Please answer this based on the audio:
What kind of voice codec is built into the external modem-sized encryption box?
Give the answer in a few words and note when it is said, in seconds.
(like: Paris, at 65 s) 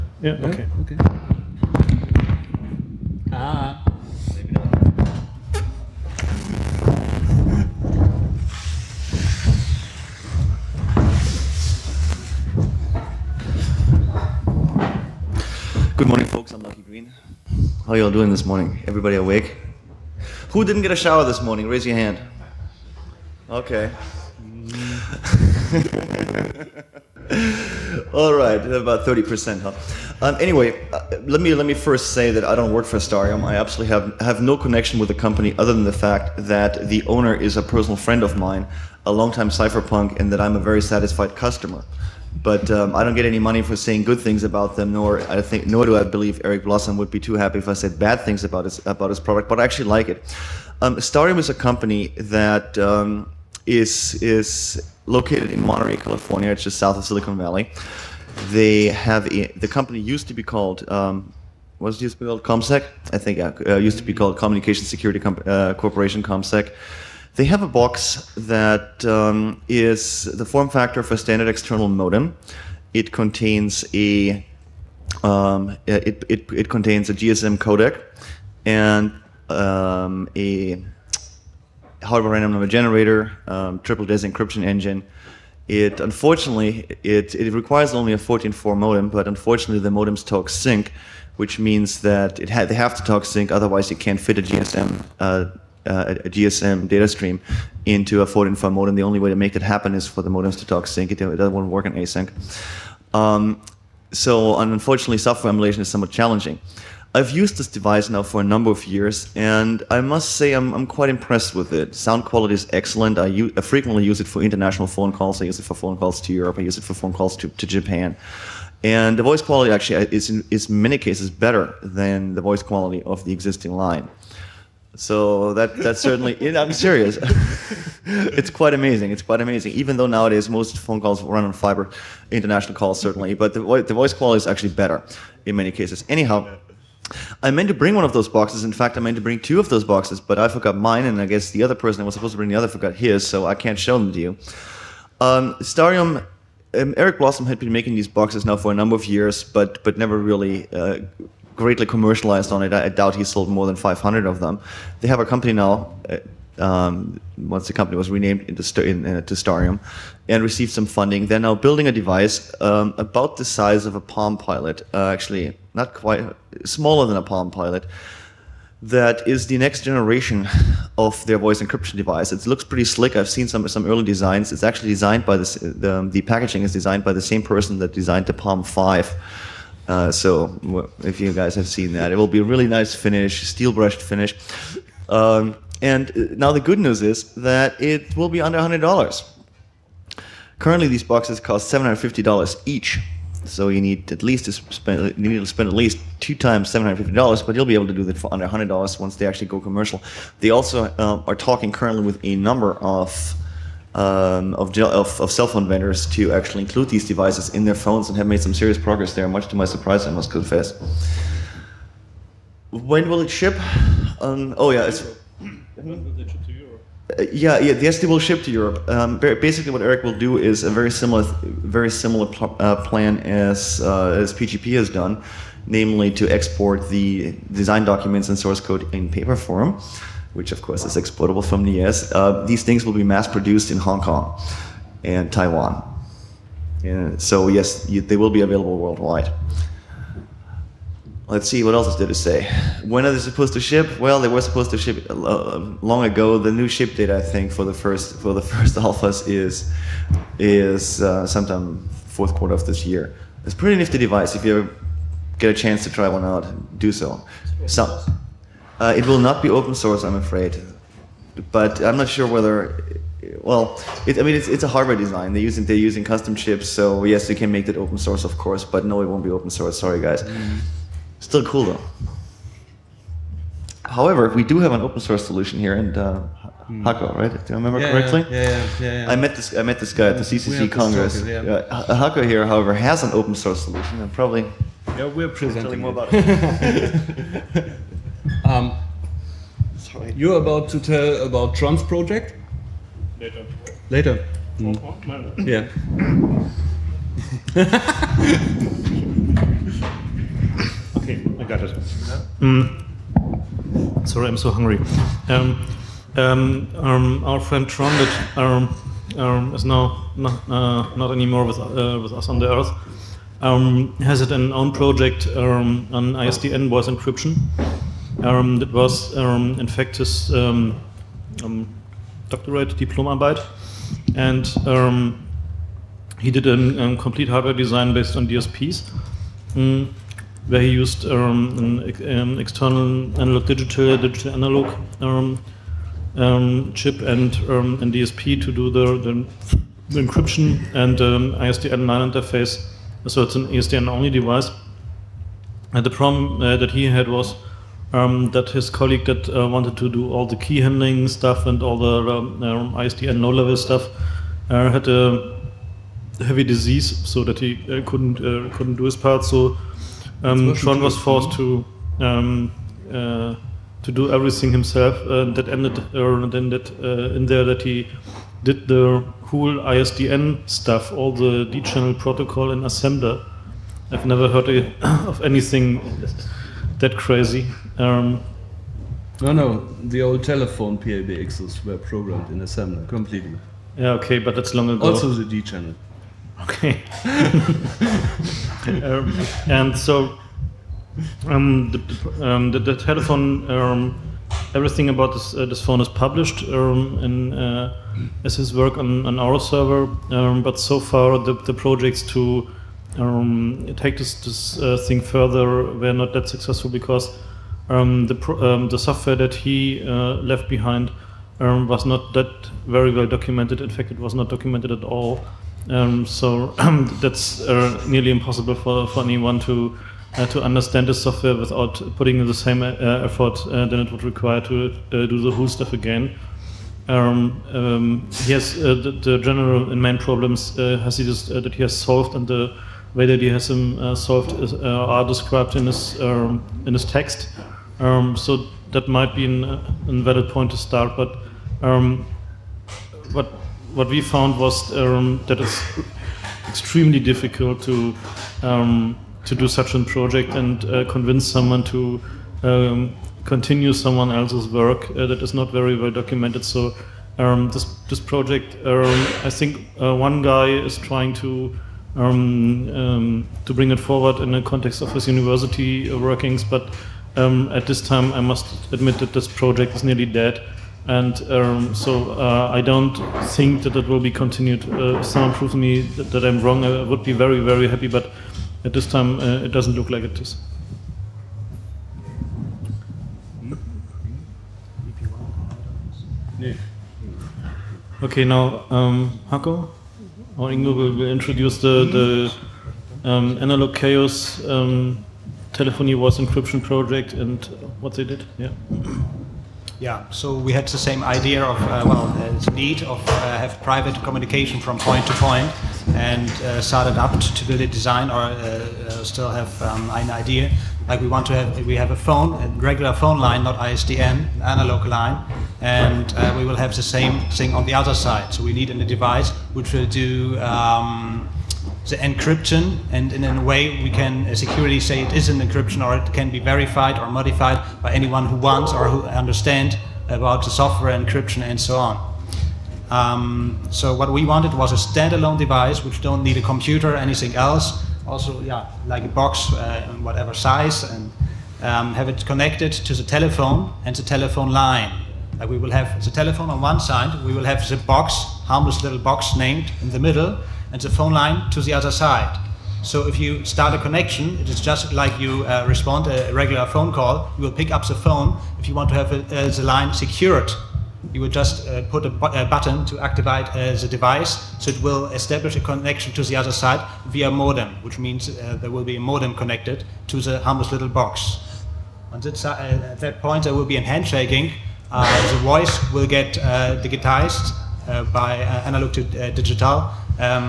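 GSM codec, at 77 s.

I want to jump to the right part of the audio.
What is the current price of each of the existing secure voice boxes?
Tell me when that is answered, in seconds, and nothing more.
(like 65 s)
191 s.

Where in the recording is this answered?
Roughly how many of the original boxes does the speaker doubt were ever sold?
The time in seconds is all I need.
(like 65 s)
153 s.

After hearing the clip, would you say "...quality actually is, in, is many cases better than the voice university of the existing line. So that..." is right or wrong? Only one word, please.
wrong.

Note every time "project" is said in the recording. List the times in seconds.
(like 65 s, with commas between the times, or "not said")
291 s, 314 s, 401 s, 449 s, 457 s, 469 s, 496 s.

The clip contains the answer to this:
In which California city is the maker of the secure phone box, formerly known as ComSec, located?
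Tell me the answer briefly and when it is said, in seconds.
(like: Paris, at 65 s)
Monterey, at 55 s.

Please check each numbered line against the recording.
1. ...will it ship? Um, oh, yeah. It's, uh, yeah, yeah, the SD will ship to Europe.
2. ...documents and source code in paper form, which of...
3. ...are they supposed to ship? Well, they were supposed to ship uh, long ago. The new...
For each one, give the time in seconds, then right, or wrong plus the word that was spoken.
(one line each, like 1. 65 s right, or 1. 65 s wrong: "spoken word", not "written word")
1. 213 s right
2. 227 s right
3. 243 s right.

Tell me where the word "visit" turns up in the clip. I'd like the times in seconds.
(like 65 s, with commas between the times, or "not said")
not said.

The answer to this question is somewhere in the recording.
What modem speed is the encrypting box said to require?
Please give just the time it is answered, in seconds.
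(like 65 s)
88 s.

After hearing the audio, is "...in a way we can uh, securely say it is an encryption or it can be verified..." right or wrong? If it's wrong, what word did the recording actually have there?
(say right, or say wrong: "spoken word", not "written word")
right.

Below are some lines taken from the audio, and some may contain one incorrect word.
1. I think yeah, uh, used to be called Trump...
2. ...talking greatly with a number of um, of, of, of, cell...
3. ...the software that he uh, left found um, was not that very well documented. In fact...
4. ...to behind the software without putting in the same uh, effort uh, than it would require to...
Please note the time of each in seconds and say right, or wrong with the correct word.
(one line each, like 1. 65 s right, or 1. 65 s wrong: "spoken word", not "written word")
1. 63 s wrong: "Communication", not "Trump"
2. 201 s wrong: "currently", not "greatly"
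3. 408 s wrong: "behind", not "found"
4. 420 s wrong: "understand", not "behind".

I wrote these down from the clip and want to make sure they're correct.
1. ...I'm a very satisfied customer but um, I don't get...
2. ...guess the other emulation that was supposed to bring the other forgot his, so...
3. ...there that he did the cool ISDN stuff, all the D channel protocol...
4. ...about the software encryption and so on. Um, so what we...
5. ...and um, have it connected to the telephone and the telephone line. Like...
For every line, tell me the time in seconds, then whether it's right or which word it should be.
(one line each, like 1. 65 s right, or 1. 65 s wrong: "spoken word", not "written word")
1. 40 s right
2. 141 s wrong: "person", not "emulation"
3. 367 s right
4. 530 s right
5. 540 s right.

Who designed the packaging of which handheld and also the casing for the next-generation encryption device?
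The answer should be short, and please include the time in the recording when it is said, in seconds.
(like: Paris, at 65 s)
Palm Five, at 178 s.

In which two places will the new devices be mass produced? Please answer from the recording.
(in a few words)
Hong Kong and Taiwan.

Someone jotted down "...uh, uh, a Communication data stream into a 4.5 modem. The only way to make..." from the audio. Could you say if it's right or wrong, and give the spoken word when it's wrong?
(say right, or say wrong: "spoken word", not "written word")
wrong: "GSM", not "Communication".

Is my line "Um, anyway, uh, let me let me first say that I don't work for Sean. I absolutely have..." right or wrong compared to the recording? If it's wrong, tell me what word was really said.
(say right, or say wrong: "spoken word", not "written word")
wrong: "Starium", not "Sean".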